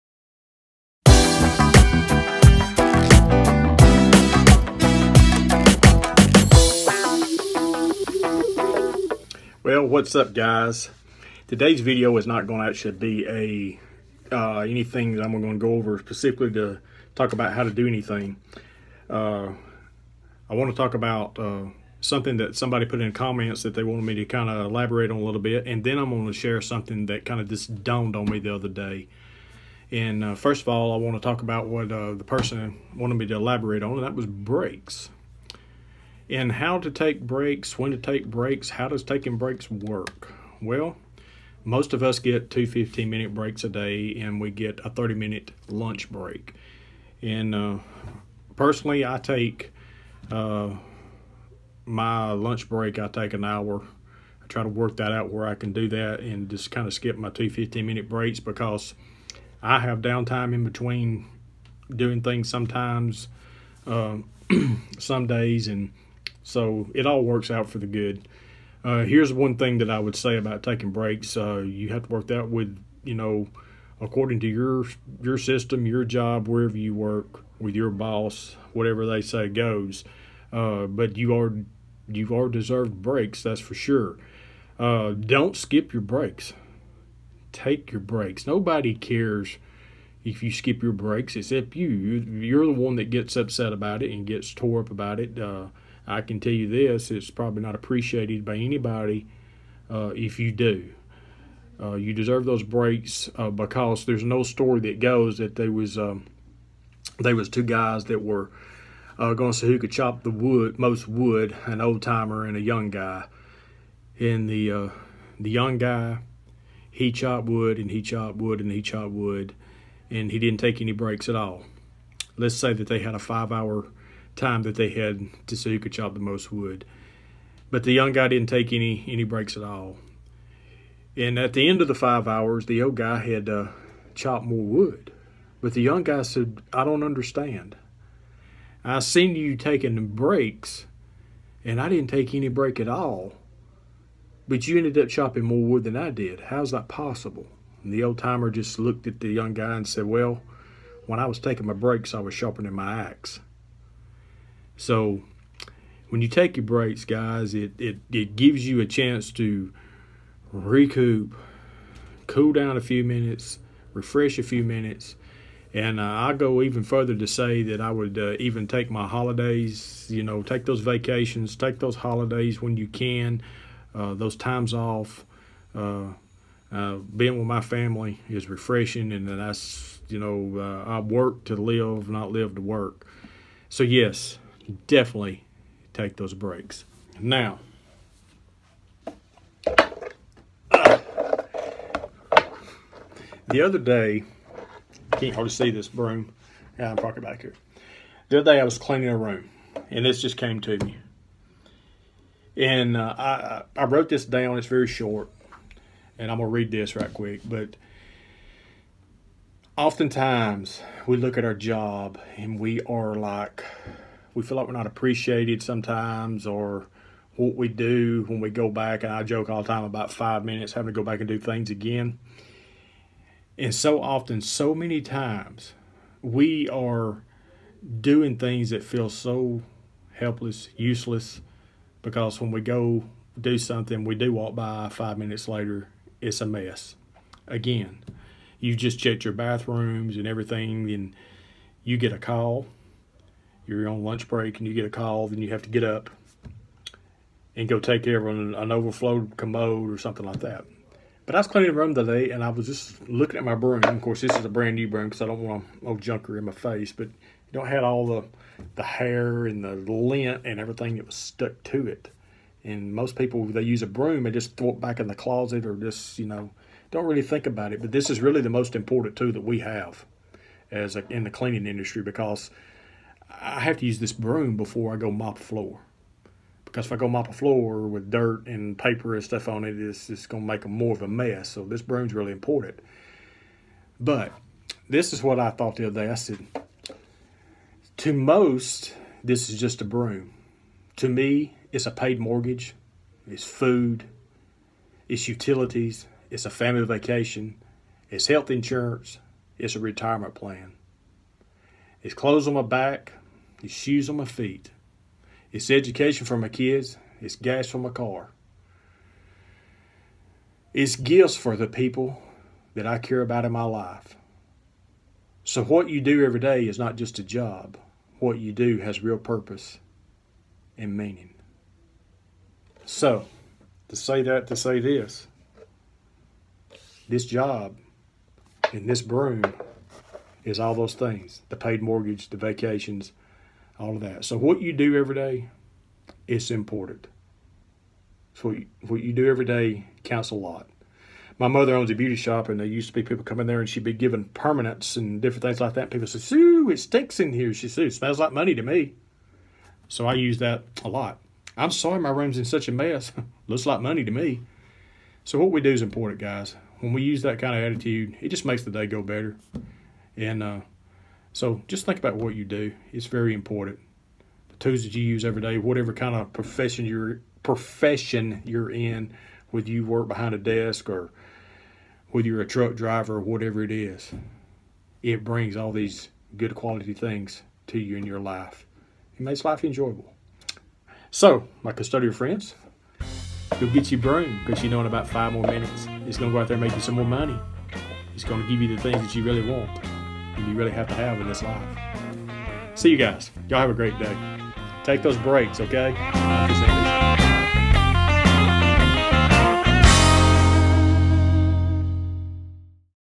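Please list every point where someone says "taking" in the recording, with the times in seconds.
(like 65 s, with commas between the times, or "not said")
39 s, 70 s, 139 s, 151 s.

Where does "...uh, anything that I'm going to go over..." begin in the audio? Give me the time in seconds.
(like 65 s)
14 s.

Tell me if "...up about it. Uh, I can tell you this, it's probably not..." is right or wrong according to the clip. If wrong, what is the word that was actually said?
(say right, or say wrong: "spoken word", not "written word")
right.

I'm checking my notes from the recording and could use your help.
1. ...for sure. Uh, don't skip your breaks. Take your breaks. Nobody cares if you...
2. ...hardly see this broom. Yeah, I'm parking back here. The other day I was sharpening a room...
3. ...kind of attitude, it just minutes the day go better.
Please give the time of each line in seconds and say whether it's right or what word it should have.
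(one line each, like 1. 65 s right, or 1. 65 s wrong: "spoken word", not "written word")
1. 83 s right
2. 195 s wrong: "cleaning", not "sharpening"
3. 357 s wrong: "makes", not "minutes".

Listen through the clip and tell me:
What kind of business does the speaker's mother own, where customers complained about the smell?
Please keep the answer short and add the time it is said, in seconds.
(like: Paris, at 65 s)
Beauty shop, at 341 s.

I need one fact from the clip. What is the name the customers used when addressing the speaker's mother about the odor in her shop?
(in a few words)
Sue.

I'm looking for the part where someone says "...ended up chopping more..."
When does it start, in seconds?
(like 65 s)
144 s.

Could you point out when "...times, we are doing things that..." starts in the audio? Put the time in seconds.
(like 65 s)
225 s.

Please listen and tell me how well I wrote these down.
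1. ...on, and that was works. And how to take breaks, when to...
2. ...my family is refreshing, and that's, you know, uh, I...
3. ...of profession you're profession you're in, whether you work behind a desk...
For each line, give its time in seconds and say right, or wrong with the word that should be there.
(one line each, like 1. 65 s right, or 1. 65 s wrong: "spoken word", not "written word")
1. 33 s wrong: "breaks", not "works"
2. 177 s right
3. 366 s right.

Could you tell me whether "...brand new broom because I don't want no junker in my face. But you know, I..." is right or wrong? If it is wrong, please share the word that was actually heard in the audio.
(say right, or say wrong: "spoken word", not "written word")
right.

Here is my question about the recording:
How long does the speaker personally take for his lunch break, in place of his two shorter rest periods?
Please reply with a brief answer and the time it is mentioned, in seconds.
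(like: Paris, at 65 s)
An hour, at 52 s.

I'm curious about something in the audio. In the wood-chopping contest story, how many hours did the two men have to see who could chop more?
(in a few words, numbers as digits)
5.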